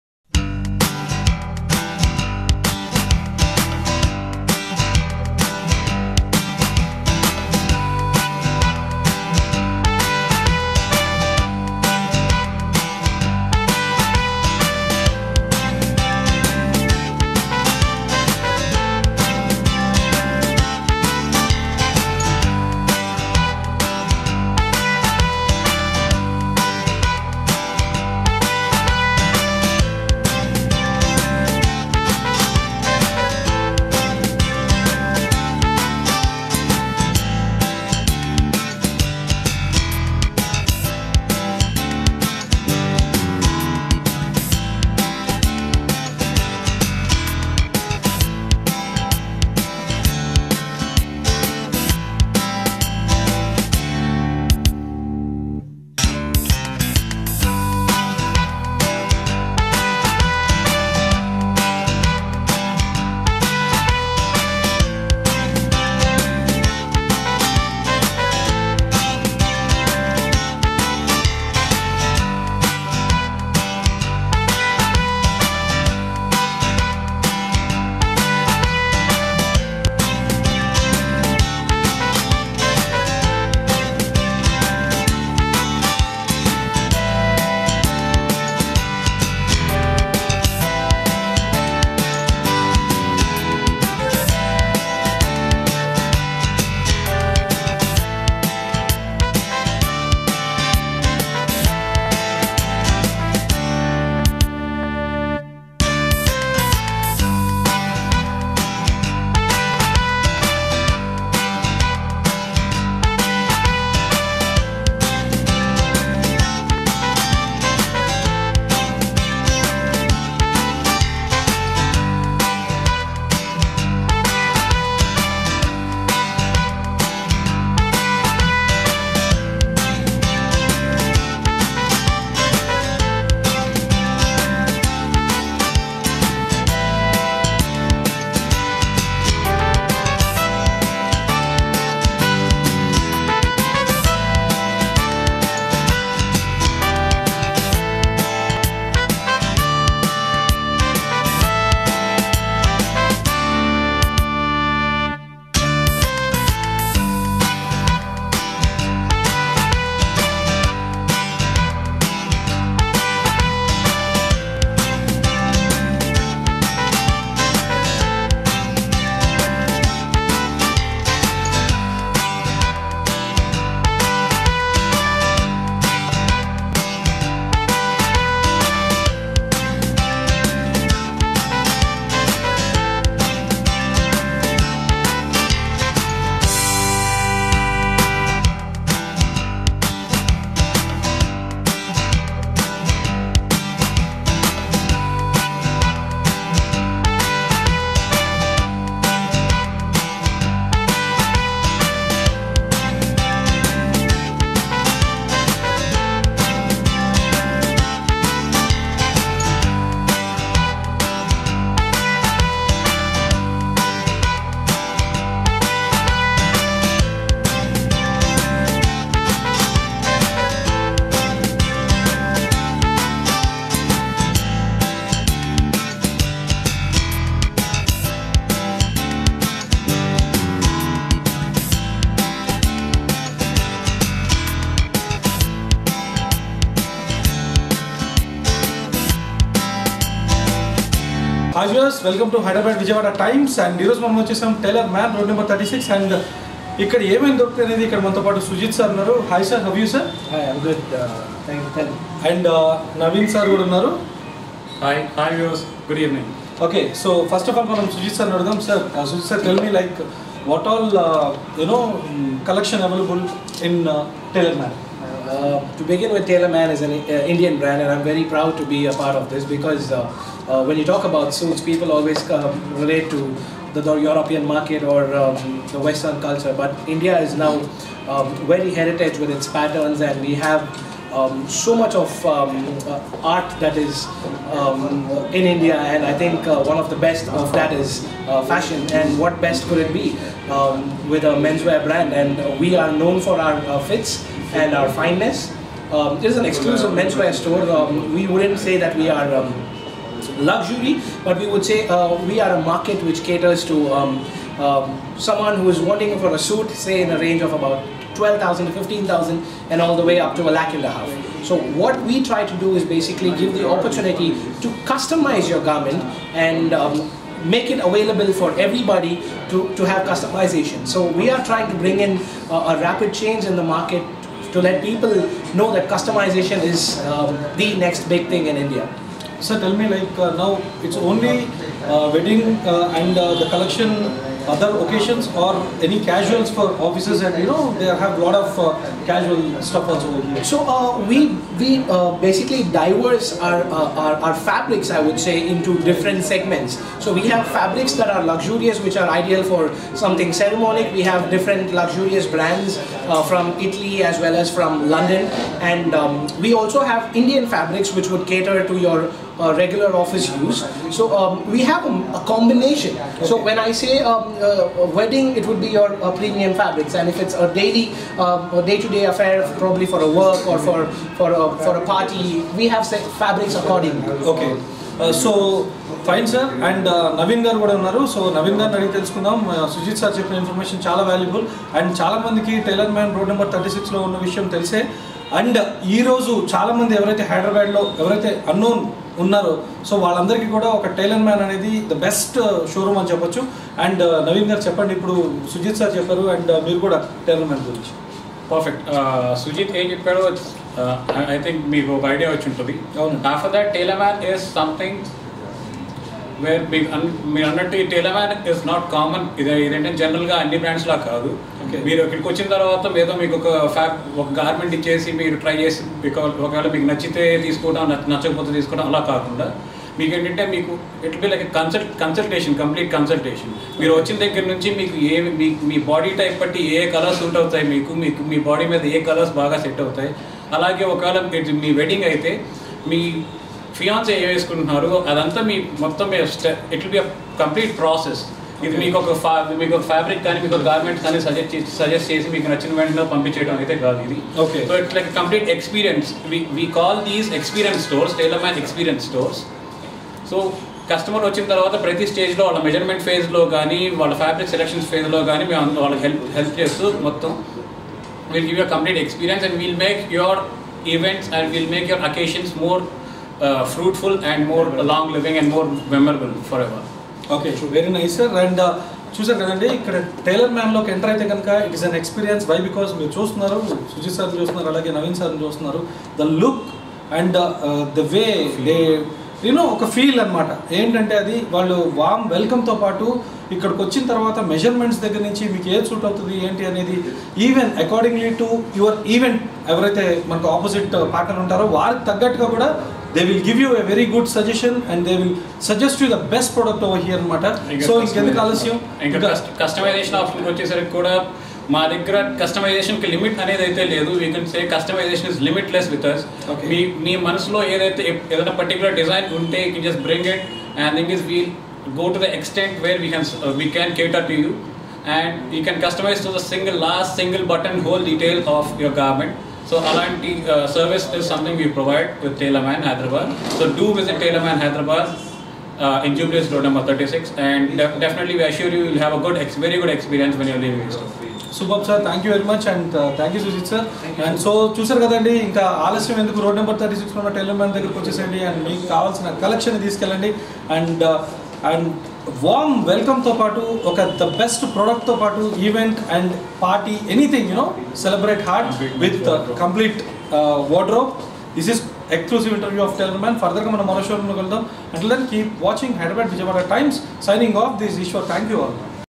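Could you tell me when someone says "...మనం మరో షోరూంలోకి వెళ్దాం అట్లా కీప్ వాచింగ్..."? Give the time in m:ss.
9:13.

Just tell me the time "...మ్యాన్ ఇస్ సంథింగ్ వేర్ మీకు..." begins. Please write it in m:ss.
6:44.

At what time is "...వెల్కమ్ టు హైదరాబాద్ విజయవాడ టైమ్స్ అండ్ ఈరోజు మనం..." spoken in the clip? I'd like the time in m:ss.
4:02.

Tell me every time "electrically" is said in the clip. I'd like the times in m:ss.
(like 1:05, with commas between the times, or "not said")
not said.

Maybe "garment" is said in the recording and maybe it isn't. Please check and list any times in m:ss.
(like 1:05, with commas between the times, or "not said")
5:15, 8:38.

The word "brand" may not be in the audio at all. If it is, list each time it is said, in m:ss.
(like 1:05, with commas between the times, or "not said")
4:27, 4:51, 5:52.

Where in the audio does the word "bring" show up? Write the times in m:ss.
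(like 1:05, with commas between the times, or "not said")
5:21.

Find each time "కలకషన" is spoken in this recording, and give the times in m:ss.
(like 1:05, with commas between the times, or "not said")
4:22, 8:59.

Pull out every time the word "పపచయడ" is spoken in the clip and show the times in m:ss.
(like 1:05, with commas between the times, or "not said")
7:23.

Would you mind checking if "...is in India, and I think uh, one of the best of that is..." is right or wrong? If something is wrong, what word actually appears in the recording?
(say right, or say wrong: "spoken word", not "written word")
right.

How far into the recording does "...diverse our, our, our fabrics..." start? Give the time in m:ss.
5:42.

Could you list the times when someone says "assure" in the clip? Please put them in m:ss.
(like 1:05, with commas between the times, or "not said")
8:48.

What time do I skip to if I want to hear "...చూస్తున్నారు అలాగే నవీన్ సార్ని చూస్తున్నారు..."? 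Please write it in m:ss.
7:54.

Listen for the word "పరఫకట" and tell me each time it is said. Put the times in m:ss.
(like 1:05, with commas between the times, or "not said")
6:38.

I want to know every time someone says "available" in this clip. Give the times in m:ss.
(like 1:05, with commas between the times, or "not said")
5:17.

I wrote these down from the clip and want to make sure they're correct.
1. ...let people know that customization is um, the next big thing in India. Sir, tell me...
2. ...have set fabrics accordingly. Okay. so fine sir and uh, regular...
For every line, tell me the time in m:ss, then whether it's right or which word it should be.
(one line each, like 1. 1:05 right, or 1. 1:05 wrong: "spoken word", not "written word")
1. 5:24 right
2. 6:12 wrong: "navindar", not "regular".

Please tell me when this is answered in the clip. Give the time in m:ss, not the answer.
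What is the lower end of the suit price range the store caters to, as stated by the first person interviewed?
5:08.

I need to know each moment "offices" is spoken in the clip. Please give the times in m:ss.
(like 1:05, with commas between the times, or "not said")
5:36, 5:59.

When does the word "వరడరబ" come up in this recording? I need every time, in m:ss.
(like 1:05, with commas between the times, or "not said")
9:10.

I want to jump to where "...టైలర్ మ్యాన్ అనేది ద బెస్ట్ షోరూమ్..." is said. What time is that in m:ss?
6:30.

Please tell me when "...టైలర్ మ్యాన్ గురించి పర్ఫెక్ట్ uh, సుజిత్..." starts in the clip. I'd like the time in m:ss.
6:37.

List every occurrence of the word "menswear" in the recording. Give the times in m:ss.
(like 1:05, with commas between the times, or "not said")
4:51, 4:56.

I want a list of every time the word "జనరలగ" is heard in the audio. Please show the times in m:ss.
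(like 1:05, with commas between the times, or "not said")
6:50.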